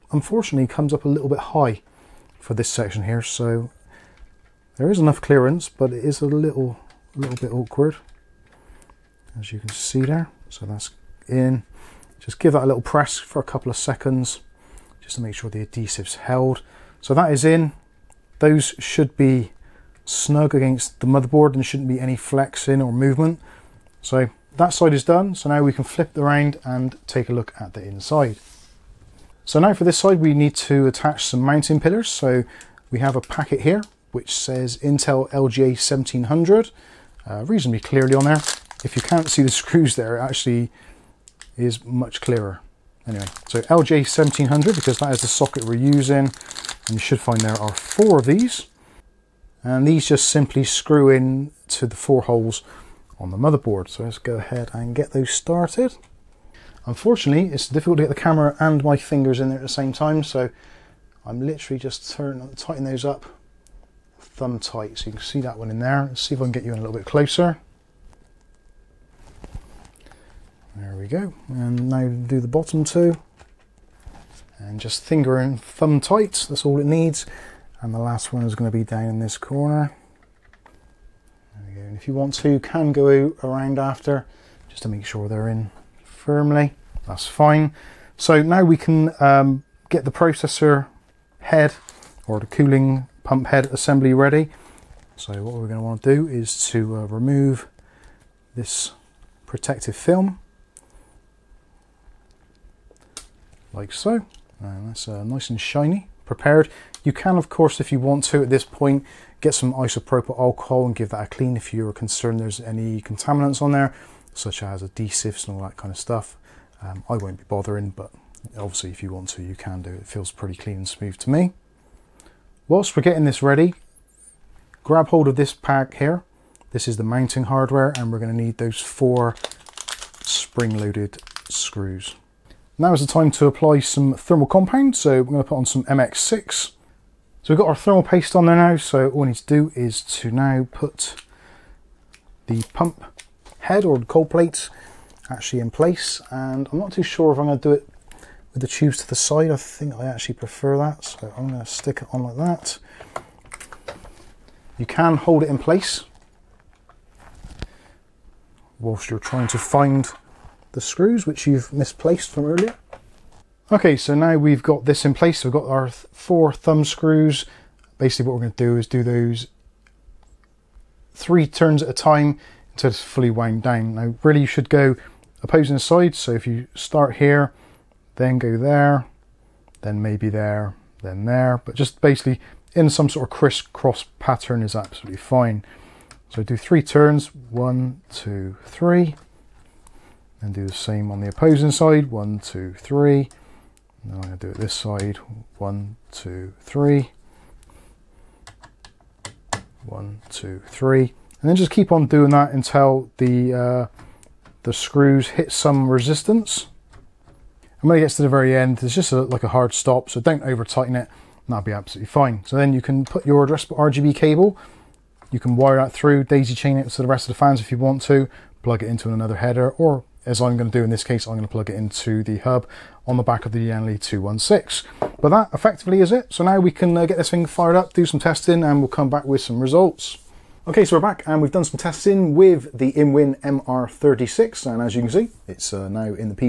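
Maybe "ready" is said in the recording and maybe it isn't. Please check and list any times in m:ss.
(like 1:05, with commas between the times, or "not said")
1:34, 2:03.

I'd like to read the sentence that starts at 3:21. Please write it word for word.
And then just keep on doing that until the, uh, the screws hit some resistance.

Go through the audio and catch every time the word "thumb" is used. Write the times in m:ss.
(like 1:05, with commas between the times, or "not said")
1:04, 1:15, 2:46.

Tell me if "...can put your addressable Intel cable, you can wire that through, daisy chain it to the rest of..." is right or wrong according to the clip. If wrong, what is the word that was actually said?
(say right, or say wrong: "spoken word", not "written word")
wrong: "RGB", not "Intel".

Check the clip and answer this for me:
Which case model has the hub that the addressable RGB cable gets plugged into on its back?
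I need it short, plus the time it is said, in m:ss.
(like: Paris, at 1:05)
Lian Li 216, at 3:43.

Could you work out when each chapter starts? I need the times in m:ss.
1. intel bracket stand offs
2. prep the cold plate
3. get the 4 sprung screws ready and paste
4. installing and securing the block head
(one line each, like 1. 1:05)
1. 0:28
2. 1:35
3. 2:02
4. 2:31.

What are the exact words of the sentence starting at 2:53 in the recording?
Now really you should go opposing sides.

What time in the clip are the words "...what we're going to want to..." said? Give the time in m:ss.
1:35.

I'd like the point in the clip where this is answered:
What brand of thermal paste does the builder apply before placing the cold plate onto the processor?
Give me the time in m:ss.
2:15.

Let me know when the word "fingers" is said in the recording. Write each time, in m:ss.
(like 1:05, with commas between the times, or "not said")
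0:58, 1:15.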